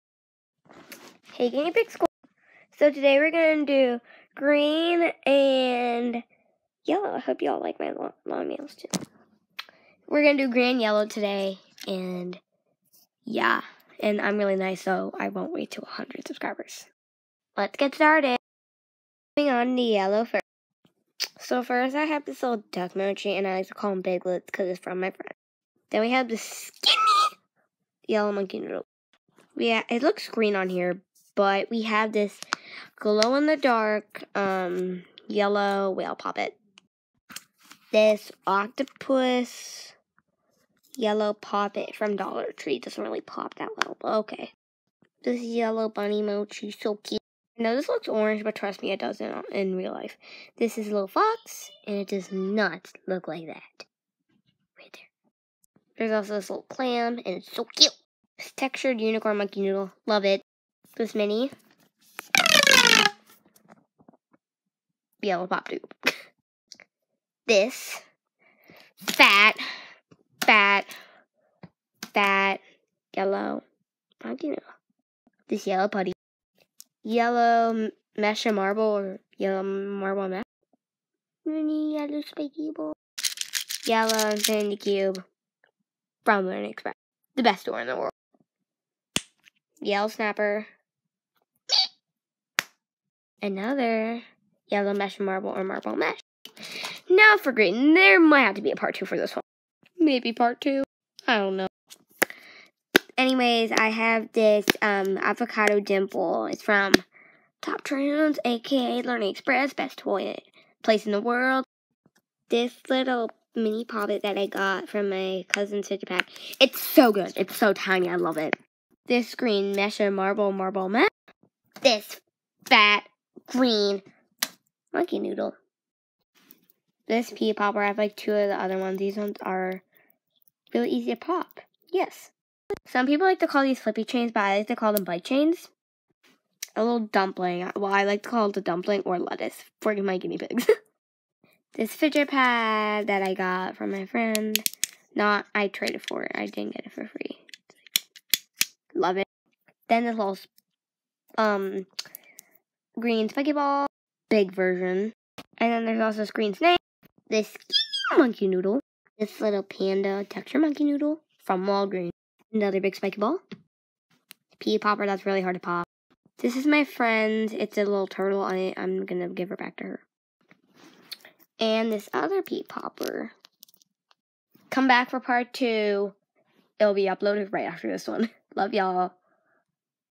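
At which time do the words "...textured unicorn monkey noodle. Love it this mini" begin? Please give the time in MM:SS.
00:58.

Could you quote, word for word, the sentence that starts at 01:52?
This little mini poppet that I got from my cousin's sister pack.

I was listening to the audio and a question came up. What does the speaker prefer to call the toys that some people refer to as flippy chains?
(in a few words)
bite chains.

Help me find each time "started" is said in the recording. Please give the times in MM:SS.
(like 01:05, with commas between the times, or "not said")
00:17.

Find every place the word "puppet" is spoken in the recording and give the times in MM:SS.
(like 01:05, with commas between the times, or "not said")
00:36, 00:41.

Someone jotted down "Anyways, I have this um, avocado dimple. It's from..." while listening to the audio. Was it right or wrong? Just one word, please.
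right.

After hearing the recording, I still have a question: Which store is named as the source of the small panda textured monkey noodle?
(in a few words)
Walgreens.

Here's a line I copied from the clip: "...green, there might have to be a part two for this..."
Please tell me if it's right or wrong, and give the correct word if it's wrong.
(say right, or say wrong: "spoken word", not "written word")
right.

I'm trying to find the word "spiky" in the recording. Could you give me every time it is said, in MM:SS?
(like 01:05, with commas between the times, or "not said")
01:22, 02:42.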